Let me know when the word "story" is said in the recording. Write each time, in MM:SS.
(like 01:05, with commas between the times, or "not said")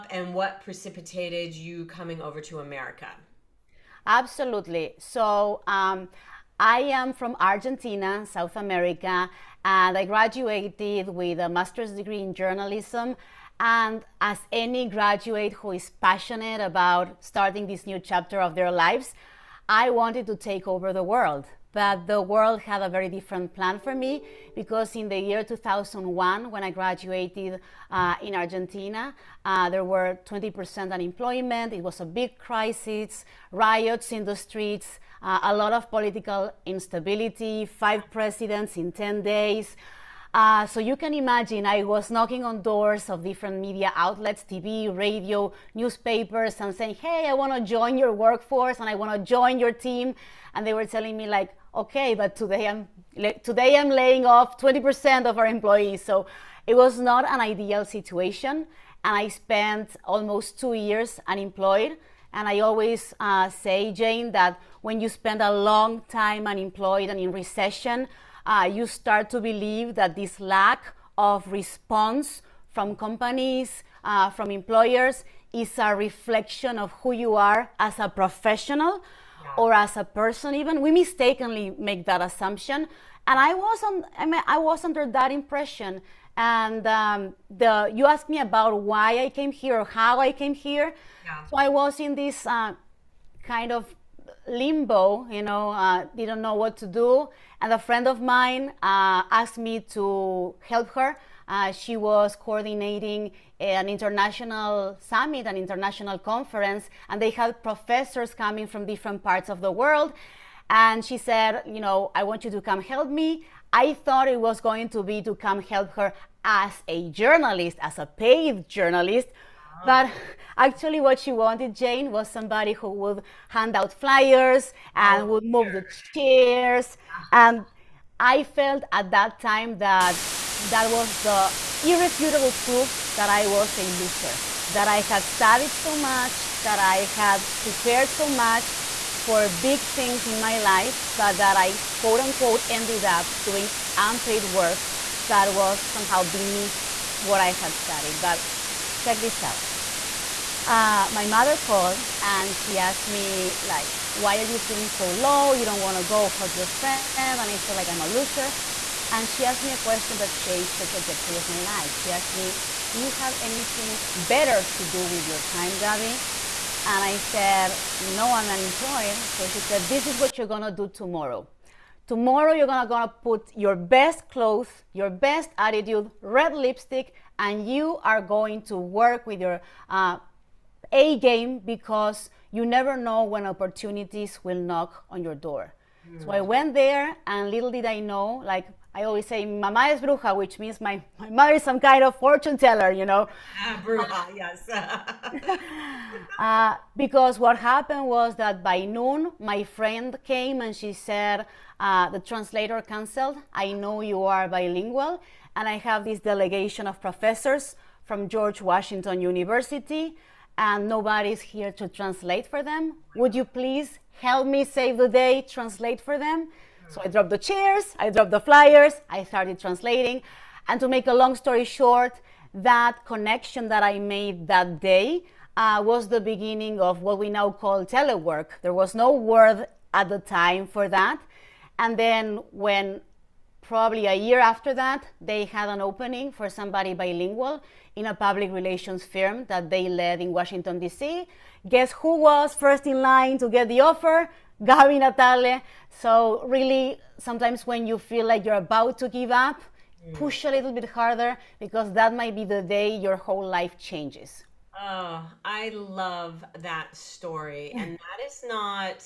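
03:41, 04:16.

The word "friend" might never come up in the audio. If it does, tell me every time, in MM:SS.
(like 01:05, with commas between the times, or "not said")
01:37, 02:36, 03:19.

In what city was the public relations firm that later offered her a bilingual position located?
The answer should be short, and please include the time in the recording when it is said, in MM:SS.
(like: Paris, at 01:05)
Washington, D.C., at 04:00.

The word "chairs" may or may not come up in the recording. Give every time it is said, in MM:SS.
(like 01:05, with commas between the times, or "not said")
02:06, 03:37.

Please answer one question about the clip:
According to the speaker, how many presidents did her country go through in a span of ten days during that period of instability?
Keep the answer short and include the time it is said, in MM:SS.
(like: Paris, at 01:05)
5, at 00:37.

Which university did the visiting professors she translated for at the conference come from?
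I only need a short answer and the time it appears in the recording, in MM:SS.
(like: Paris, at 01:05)
George Washington University, at 03:28.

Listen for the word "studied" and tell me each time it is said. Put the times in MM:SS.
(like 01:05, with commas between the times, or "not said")
02:15, 02:27.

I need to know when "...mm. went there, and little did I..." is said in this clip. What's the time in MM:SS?
03:06.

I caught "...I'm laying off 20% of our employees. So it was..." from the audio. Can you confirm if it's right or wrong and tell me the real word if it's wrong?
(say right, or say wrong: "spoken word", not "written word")
right.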